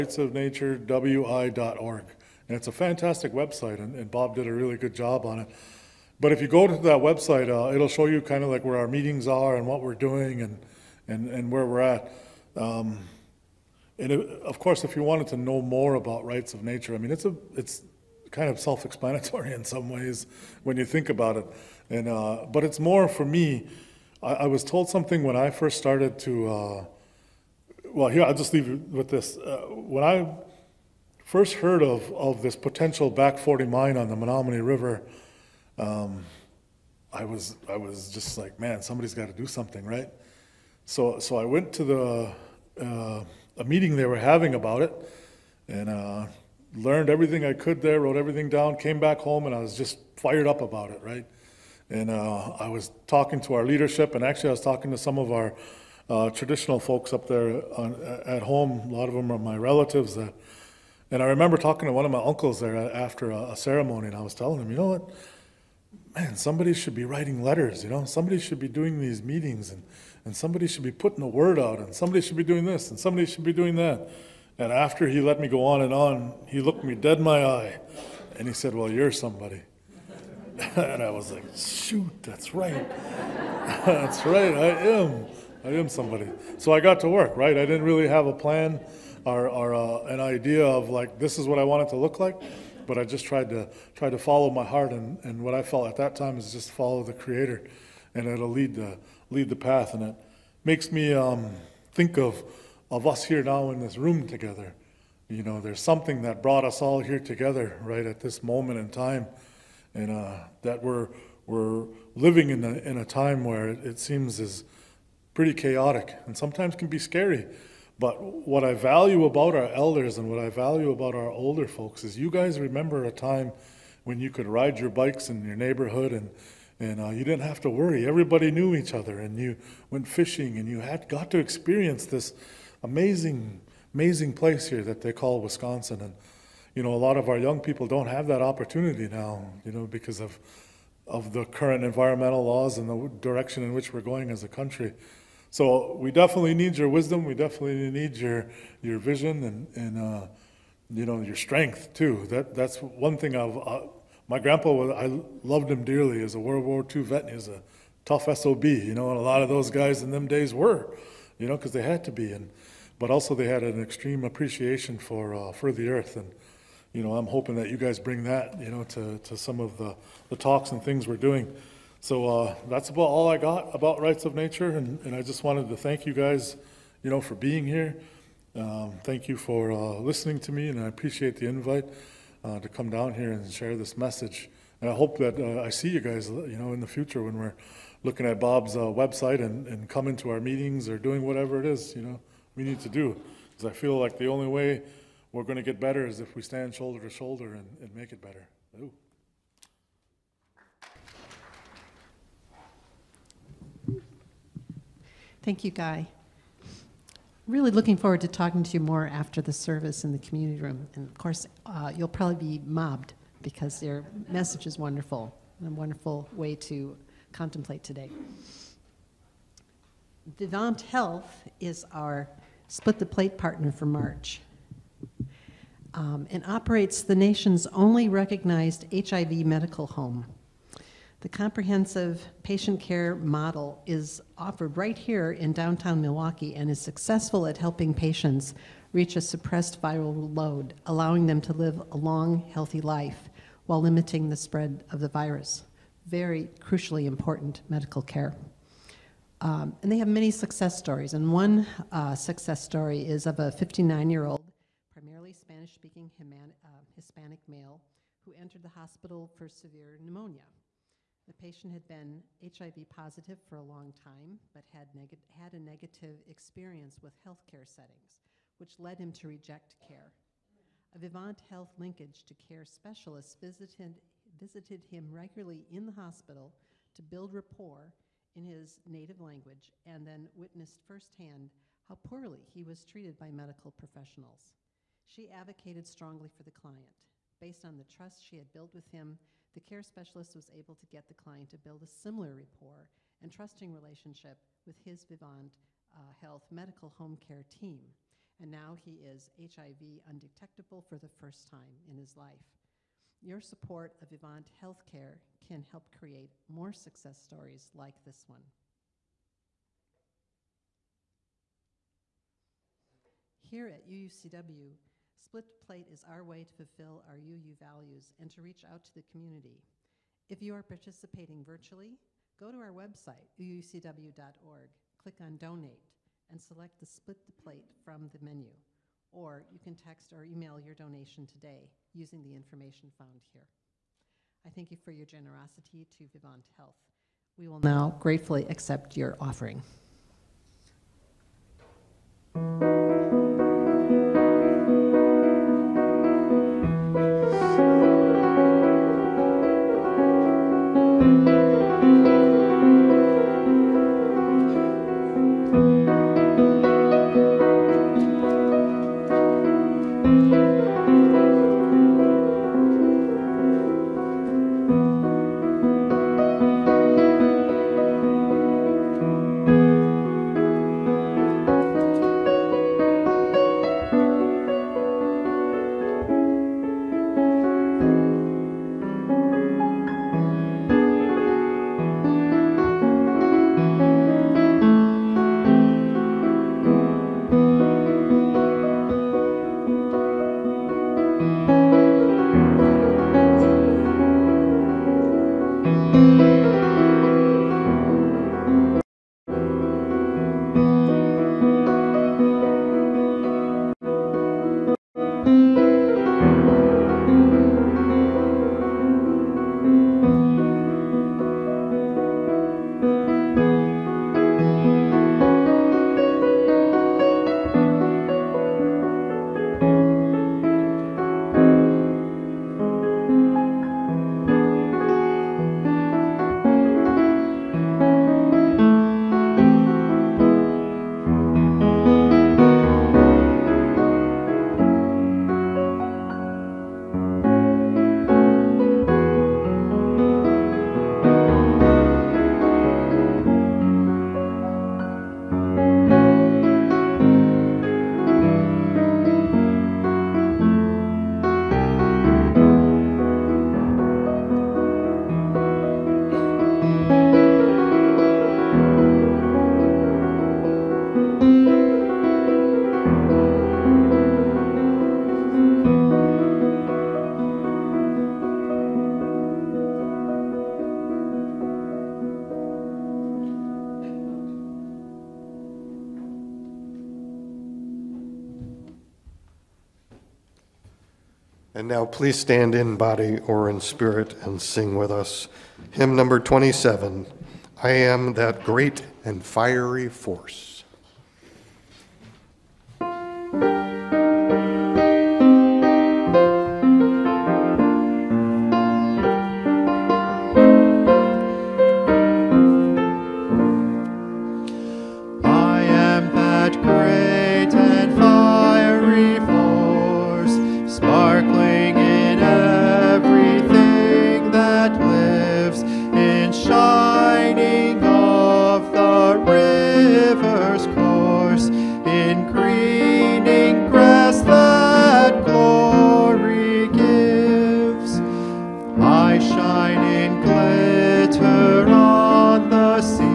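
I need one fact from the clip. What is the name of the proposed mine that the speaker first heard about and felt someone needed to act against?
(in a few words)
Back 40.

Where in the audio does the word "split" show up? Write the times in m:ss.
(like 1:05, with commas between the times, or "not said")
3:42, 5:15, 5:26.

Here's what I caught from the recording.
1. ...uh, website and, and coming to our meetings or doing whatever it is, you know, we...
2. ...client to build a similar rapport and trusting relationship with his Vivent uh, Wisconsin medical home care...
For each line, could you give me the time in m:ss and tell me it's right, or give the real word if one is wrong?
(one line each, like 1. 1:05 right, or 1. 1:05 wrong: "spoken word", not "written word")
1. 3:08 right
2. 4:51 wrong: "Health", not "Wisconsin".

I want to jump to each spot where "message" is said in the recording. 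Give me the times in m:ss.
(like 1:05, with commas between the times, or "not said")
3:03, 3:34.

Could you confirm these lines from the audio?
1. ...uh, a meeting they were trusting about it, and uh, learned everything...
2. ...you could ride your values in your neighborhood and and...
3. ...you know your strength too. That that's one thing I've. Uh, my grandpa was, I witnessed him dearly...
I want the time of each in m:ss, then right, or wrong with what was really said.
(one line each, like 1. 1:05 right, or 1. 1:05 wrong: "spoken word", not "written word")
1. 0:42 wrong: "having", not "trusting"
2. 2:04 wrong: "bikes", not "values"
3. 2:30 wrong: "loved", not "witnessed".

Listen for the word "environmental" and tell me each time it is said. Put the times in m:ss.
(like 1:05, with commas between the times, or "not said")
2:21.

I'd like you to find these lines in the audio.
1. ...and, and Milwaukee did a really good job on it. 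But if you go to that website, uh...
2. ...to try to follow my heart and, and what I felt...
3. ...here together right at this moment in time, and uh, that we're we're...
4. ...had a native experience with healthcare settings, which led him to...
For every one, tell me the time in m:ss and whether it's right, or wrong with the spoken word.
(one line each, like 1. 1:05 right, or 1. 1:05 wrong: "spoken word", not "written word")
1. 0:03 wrong: "Bob", not "Milwaukee"
2. 1:33 right
3. 1:46 right
4. 4:25 wrong: "negative", not "native".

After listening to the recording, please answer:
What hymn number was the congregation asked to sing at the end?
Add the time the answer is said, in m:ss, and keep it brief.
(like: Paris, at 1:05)
27, at 8:06.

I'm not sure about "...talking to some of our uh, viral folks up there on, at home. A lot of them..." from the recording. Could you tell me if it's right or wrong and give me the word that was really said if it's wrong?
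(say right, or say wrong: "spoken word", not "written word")
wrong: "traditional", not "viral".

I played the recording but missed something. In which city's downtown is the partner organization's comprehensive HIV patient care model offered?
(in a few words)
Milwaukee.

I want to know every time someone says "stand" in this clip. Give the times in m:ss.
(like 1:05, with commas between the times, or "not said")
3:16, 8:02.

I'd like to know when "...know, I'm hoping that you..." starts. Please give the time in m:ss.
2:47.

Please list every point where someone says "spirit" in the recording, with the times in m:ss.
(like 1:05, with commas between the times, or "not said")
8:03.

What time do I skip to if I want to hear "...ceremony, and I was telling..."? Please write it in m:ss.
1:03.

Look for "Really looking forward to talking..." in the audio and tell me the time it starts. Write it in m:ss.
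3:27.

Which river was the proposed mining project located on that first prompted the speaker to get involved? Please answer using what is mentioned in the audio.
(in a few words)
Menominee River.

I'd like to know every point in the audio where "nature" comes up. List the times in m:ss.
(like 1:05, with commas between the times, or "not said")
0:16, 2:54.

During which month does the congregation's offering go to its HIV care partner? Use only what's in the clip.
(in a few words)
March.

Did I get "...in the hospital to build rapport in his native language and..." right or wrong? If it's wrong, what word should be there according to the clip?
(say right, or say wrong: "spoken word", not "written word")
right.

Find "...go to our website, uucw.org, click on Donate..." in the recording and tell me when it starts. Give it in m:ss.
5:22.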